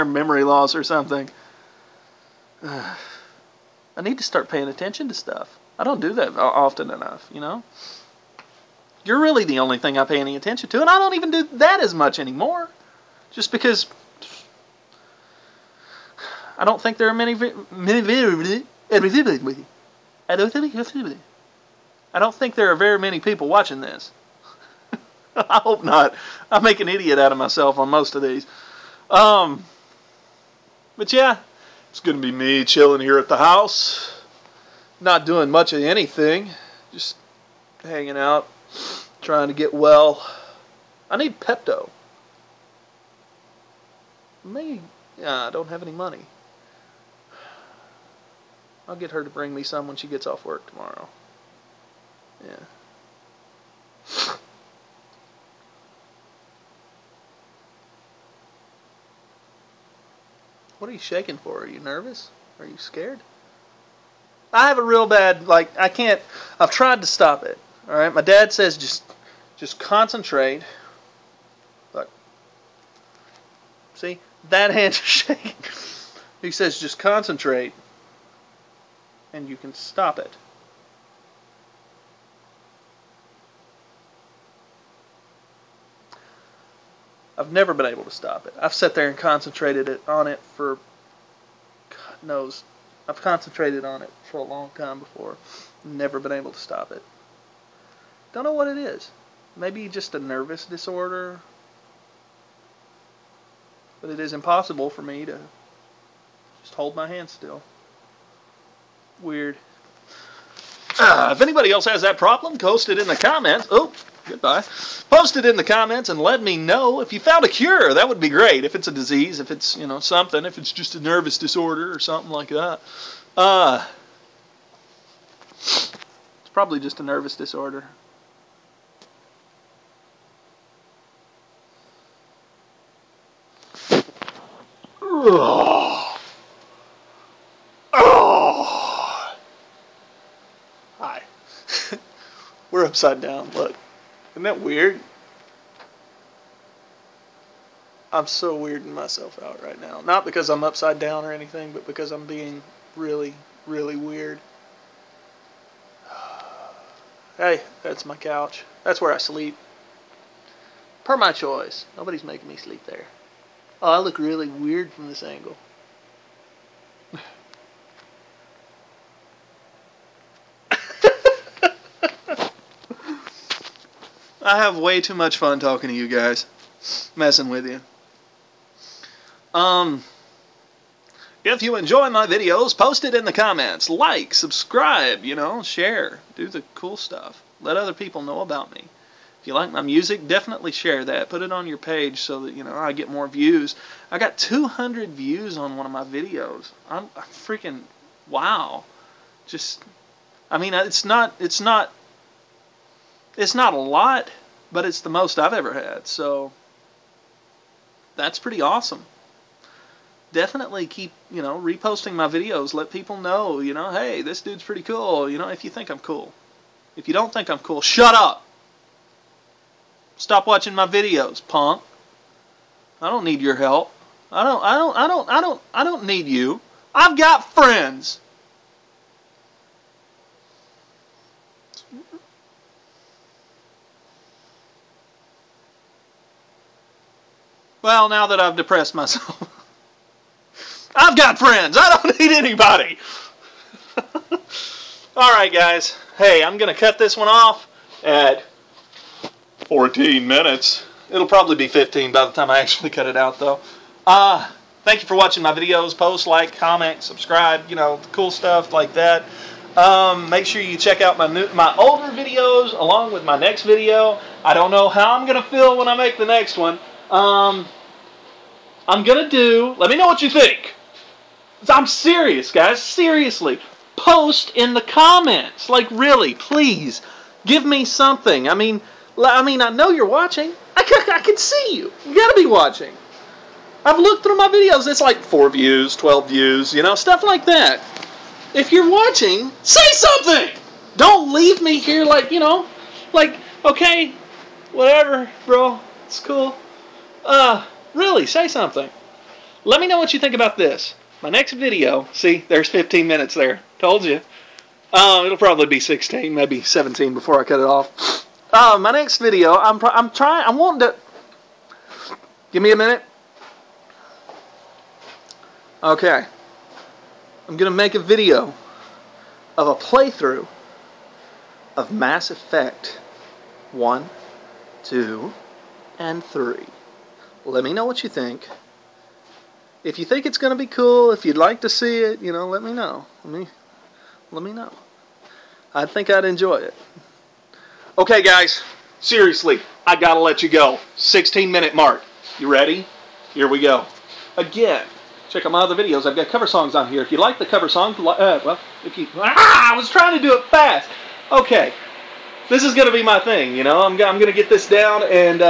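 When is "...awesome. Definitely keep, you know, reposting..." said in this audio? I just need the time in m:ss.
3:28.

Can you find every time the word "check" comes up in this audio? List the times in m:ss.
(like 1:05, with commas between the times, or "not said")
4:20, 5:45.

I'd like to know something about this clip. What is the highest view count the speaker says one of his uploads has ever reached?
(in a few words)
200.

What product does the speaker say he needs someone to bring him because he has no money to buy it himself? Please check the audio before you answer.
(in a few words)
Pepto.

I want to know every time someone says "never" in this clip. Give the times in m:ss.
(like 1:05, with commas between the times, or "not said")
1:27, 1:35.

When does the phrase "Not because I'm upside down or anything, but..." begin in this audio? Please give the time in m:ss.
2:30.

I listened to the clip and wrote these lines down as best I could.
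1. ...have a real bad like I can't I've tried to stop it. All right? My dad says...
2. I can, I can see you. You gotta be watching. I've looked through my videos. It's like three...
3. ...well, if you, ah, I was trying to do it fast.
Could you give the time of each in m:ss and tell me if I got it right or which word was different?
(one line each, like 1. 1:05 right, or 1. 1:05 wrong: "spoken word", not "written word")
1. 1:04 right
2. 4:40 wrong: "four", not "three"
3. 5:48 right.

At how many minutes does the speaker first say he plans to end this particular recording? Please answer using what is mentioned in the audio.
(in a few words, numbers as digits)
14 minutes.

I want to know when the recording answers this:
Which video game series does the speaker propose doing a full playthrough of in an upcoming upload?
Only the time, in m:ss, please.
5:21.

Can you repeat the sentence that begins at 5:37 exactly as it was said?
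Okay, guys, seriously, I got to let you go.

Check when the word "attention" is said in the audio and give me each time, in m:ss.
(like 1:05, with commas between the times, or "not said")
0:04, 0:10.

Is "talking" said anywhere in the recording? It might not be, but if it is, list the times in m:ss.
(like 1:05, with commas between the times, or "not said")
2:55.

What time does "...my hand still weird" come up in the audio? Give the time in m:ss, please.
1:46.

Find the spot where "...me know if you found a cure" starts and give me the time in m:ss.
1:56.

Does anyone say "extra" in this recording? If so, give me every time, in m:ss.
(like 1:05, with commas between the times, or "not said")
not said.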